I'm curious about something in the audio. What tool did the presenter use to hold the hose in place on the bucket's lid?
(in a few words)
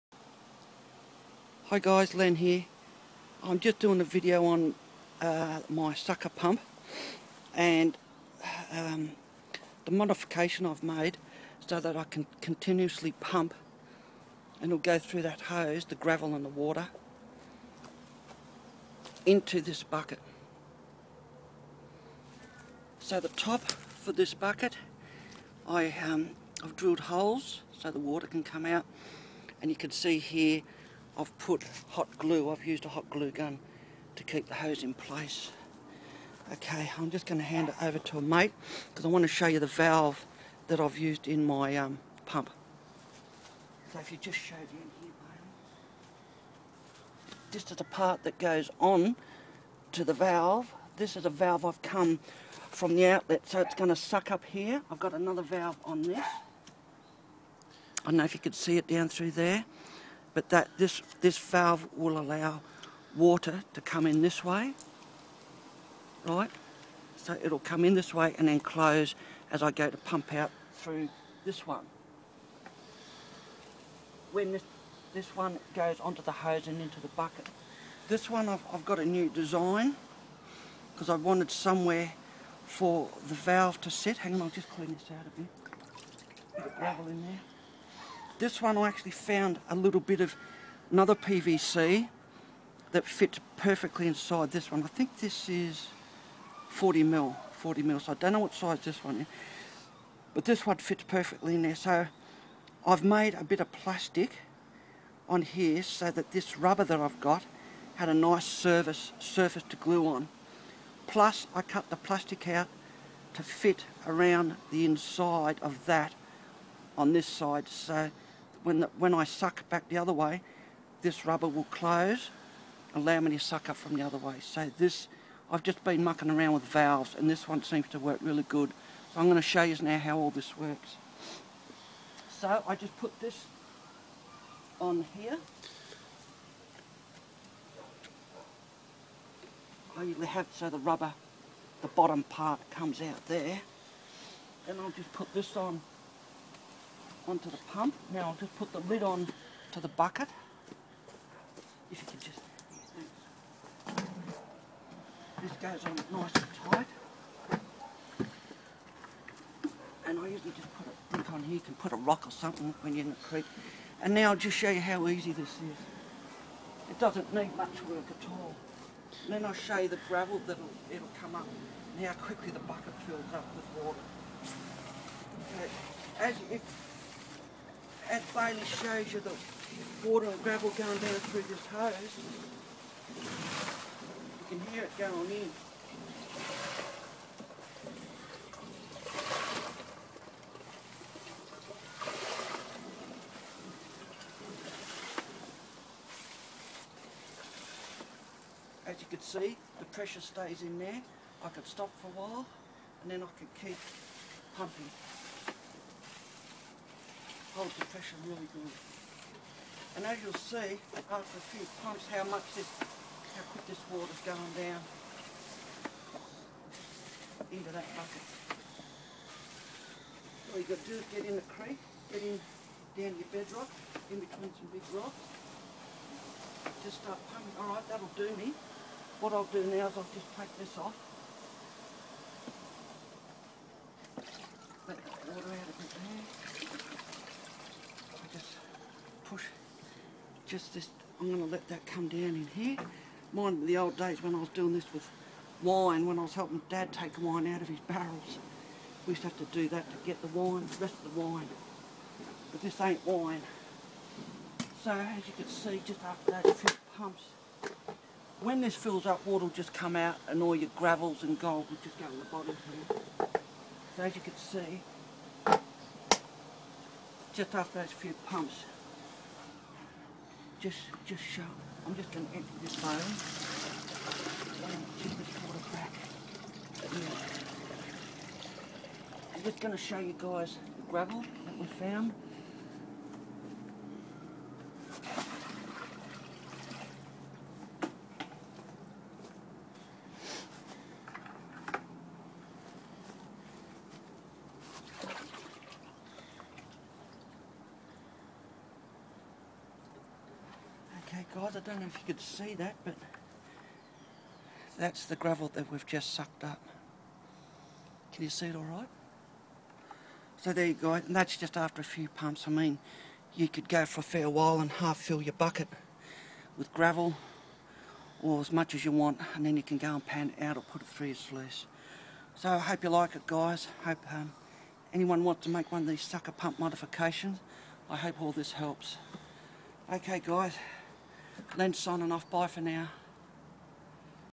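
Hot glue gun.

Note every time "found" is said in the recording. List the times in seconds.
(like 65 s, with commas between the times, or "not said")
89 s, 281 s.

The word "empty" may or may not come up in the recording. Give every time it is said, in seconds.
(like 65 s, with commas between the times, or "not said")
272 s.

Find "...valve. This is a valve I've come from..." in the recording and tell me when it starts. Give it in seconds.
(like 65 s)
50 s.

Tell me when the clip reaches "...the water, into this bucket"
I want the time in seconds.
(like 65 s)
16 s.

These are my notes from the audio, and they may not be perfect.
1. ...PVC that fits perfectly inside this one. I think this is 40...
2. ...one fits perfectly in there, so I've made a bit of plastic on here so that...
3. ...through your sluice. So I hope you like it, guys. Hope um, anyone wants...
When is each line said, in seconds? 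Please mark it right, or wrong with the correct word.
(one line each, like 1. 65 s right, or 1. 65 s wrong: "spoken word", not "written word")
1. 91 s right
2. 100 s right
3. 320 s right.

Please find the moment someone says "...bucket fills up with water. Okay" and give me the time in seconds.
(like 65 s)
172 s.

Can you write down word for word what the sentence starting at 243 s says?
Mind the old days when I was doing this with wine, when I was helping Dad take wine out of his barrels.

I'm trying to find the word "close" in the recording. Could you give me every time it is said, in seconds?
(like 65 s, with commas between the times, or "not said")
68 s, 121 s.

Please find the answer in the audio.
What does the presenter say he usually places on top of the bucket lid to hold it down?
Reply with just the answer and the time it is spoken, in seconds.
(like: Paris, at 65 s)
A brick, at 160 s.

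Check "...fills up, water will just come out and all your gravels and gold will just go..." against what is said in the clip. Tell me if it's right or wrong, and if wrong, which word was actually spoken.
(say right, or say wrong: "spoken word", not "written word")
right.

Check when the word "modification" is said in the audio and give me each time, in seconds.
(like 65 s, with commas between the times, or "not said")
9 s, 326 s.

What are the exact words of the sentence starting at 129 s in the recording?
So I'm going to show you now how all this works.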